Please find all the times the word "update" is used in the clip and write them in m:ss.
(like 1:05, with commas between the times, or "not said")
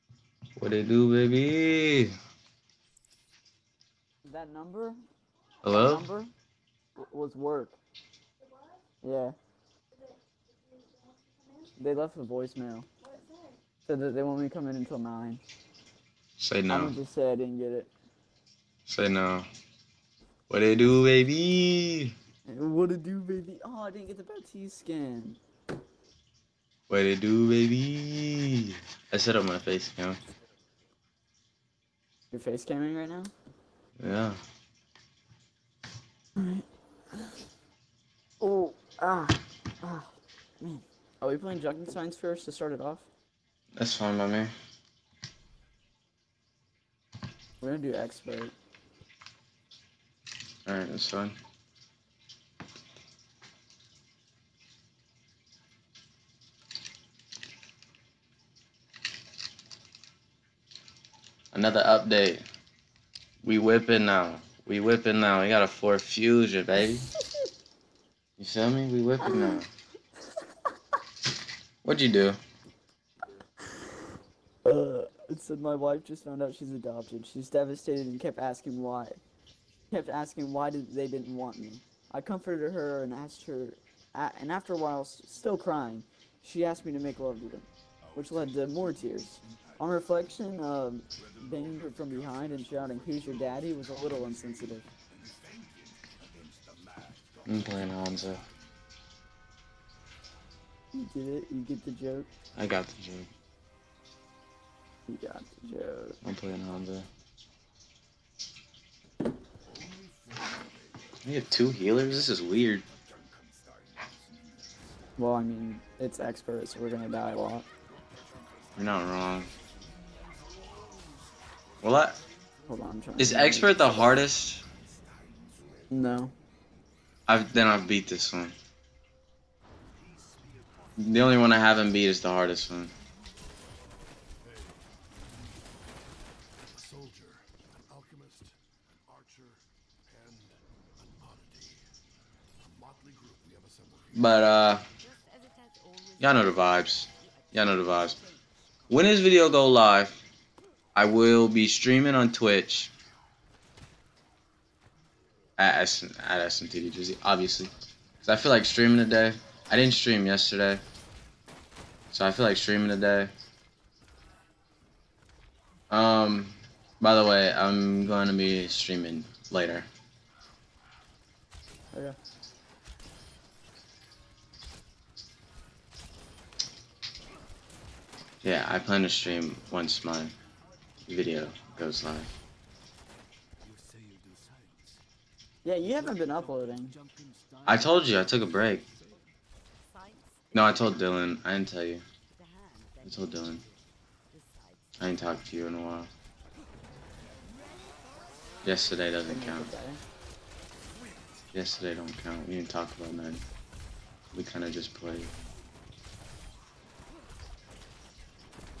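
1:01.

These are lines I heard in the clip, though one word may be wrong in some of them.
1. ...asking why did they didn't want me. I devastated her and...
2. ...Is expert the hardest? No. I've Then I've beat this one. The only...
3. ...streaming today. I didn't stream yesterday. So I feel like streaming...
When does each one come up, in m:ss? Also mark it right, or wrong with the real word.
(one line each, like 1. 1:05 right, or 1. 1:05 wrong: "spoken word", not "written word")
1. 1:20 wrong: "comforted", not "devastated"
2. 2:03 right
3. 2:38 right.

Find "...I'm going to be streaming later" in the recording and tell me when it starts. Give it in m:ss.
2:47.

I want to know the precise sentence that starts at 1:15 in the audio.
It said my wife just found out she's adopted.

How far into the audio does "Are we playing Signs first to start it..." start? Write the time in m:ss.
0:41.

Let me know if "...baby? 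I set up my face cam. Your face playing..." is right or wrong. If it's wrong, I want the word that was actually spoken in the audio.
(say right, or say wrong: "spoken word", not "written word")
wrong: "camming", not "playing".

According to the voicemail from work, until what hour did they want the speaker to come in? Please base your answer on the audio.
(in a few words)
9.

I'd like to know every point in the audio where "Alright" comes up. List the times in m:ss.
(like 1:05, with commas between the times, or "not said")
0:36, 0:50.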